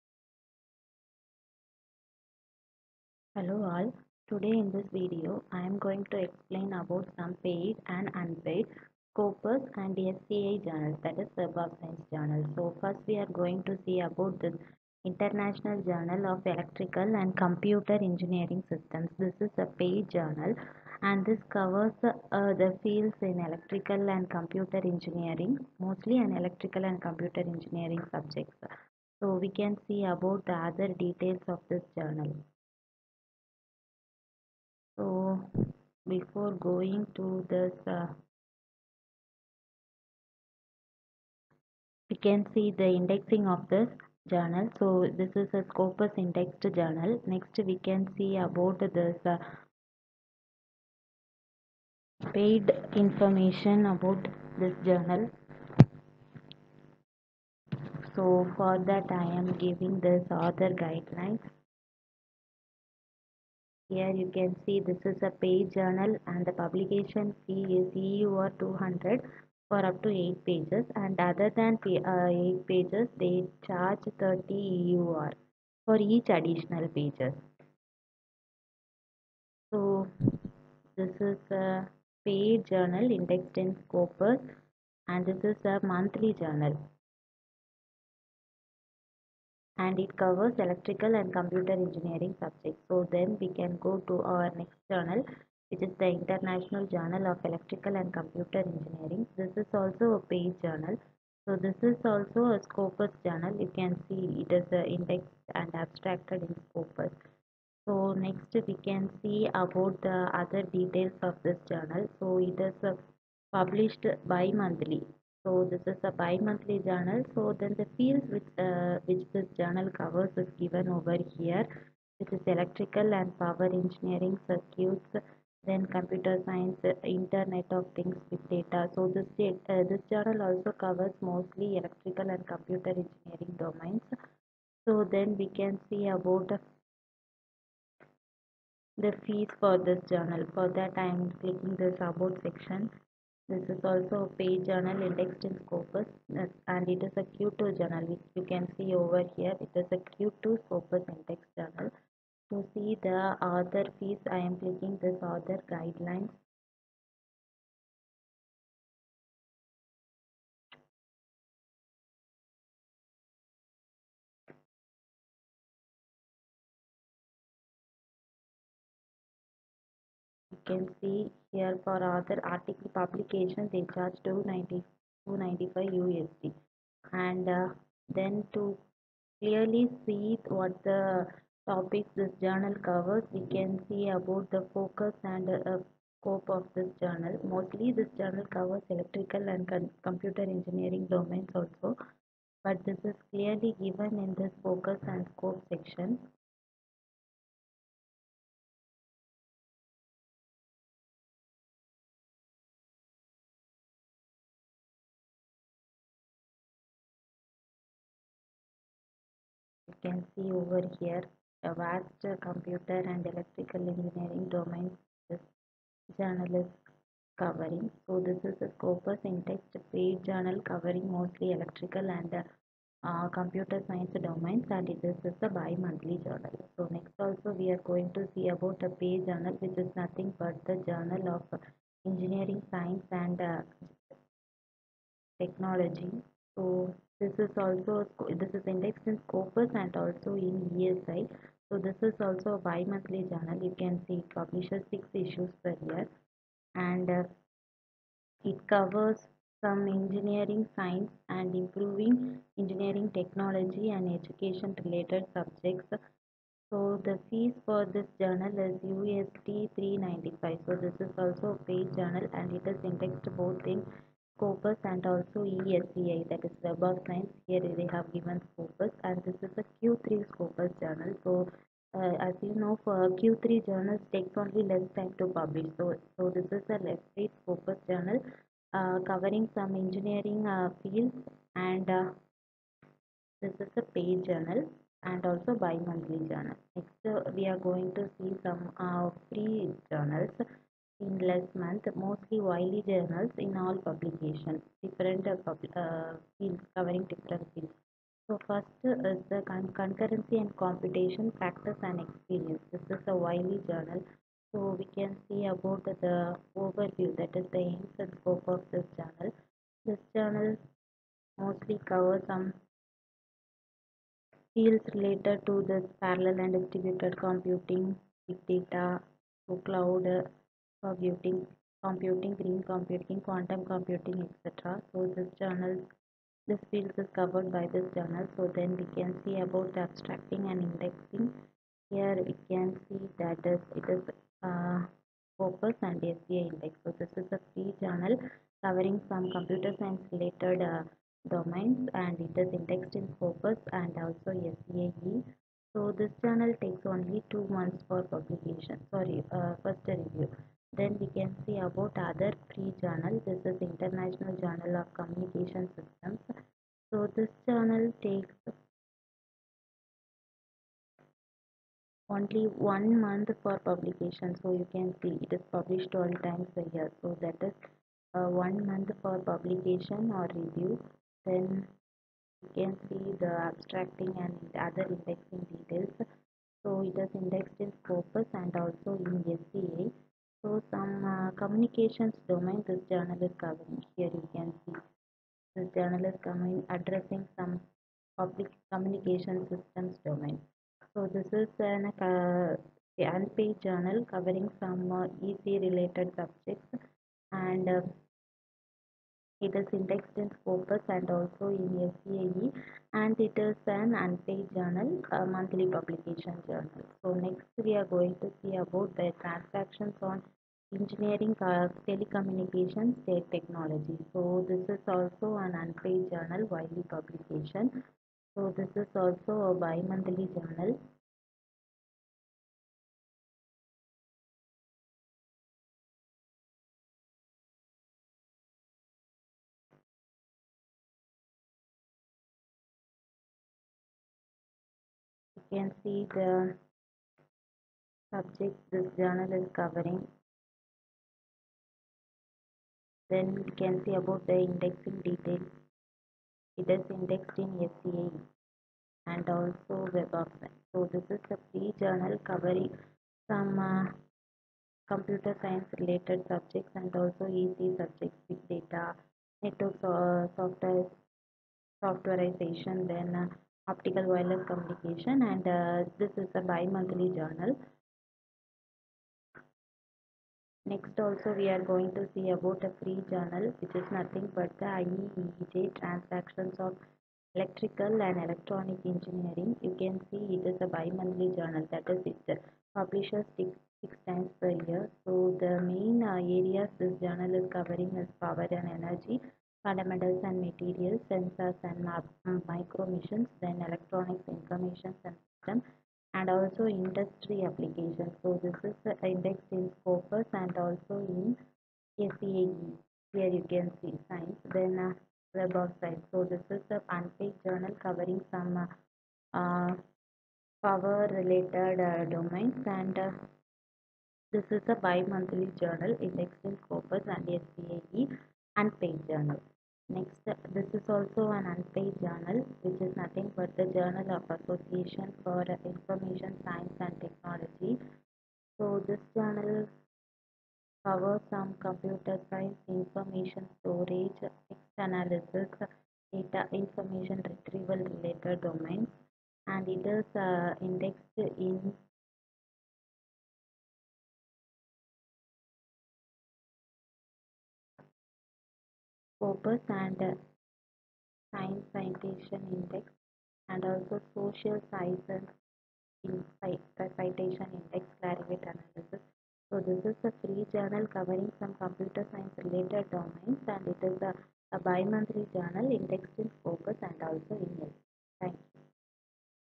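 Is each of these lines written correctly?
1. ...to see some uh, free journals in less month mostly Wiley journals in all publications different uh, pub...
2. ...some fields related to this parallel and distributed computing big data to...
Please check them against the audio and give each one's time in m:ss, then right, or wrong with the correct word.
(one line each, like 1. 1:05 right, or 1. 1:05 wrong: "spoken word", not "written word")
1. 4:47 right
2. 5:12 right.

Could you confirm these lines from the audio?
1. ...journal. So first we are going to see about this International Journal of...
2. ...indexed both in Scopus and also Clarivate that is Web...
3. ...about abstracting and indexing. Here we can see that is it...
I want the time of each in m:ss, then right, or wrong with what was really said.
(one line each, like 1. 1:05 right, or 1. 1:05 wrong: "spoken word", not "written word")
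1. 0:12 right
2. 4:22 wrong: "ESCI", not "Clarivate"
3. 5:29 right.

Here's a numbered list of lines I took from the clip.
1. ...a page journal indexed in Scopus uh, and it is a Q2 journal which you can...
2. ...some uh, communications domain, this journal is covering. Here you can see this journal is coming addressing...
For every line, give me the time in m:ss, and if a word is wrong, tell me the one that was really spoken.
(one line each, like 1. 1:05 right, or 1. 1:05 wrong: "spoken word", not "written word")
1. 2:24 right
2. 6:20 right.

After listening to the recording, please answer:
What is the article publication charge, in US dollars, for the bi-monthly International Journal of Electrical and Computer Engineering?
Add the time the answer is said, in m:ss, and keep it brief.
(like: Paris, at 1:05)
295 USD, at 2:55.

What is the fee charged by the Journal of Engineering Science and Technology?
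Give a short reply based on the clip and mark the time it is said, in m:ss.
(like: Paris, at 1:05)
USD 395, at 4:18.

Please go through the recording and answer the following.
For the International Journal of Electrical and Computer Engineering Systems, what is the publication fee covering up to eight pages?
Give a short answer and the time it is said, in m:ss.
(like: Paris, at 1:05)
EUR 200, at 1:07.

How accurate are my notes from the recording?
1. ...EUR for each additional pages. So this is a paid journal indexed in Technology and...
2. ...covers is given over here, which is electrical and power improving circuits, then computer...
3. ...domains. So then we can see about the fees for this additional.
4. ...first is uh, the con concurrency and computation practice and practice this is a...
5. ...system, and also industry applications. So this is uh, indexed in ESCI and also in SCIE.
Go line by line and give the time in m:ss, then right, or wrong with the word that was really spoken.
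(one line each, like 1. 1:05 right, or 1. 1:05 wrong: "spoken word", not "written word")
1. 1:14 wrong: "Scopus", not "Technology"
2. 1:59 wrong: "engineering", not "improving"
3. 2:13 wrong: "journal", not "additional"
4. 4:58 wrong: "experience", not "practice"
5. 8:15 wrong: "Scopus", not "ESCI".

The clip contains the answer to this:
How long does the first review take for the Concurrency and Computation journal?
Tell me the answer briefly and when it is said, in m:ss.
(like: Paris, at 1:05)
two months, at 5:47.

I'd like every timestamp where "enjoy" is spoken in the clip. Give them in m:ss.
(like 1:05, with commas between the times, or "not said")
not said.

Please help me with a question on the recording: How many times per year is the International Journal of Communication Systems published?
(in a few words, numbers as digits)
12.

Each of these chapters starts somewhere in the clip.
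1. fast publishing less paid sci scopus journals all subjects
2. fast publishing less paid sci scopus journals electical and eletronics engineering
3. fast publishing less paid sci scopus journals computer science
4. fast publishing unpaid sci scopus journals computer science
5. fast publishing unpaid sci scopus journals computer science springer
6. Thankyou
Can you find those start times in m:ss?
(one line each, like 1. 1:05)
1. 0:14
2. 1:17
3. 2:20
4. 4:17
5. 5:10
6. 6:27.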